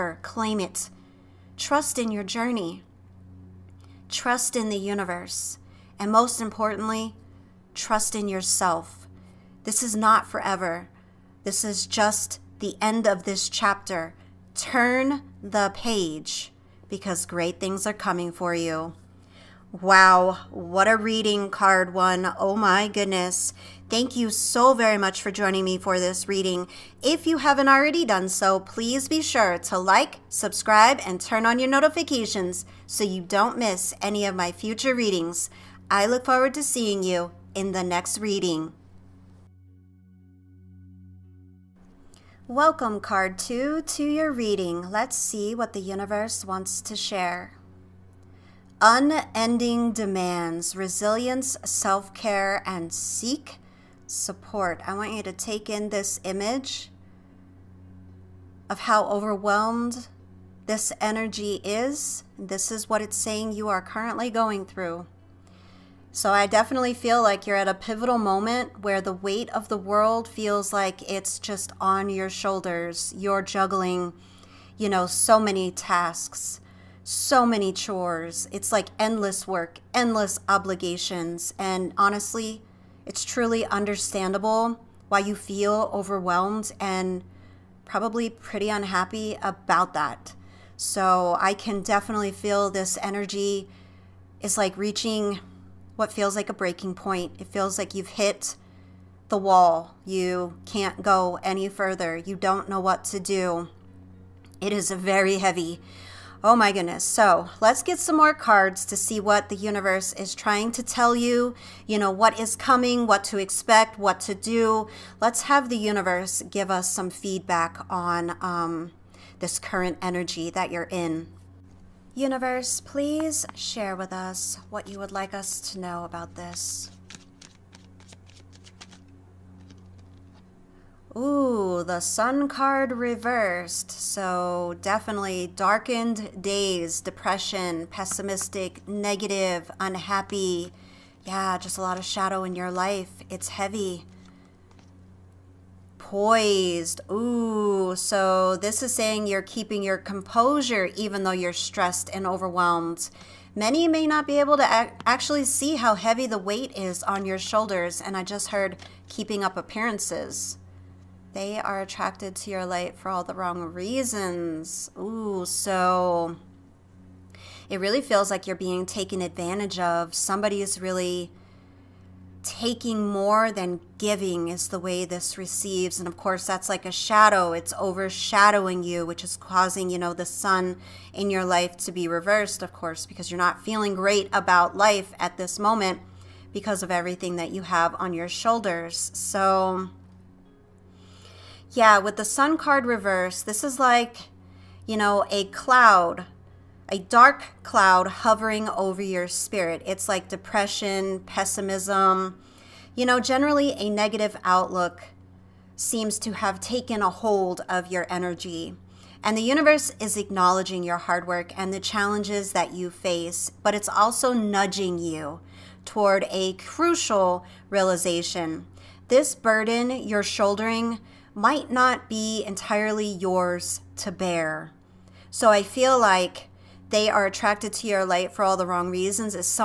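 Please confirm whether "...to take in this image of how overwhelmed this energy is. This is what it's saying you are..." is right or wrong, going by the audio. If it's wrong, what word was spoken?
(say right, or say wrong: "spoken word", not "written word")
right.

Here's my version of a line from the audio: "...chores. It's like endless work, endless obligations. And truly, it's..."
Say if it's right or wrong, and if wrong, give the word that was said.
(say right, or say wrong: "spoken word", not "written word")
wrong: "honestly", not "truly".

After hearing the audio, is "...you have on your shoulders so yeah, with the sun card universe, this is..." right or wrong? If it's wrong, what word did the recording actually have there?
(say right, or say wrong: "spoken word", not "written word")
wrong: "reverse", not "universe".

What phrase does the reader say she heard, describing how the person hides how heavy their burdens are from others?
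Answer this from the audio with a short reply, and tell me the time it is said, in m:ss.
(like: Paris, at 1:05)
keeping up appearances, at 2:39.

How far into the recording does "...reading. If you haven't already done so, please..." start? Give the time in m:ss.
0:26.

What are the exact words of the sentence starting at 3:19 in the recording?
It's like depression, pessimism, you know, generally a negative outlook seems to have taken a hold of your energy.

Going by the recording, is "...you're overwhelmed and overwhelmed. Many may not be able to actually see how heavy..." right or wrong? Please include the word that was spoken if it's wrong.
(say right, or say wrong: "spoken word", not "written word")
wrong: "stressed", not "overwhelmed".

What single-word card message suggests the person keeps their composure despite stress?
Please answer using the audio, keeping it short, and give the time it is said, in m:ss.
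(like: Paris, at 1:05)
Poised, at 2:25.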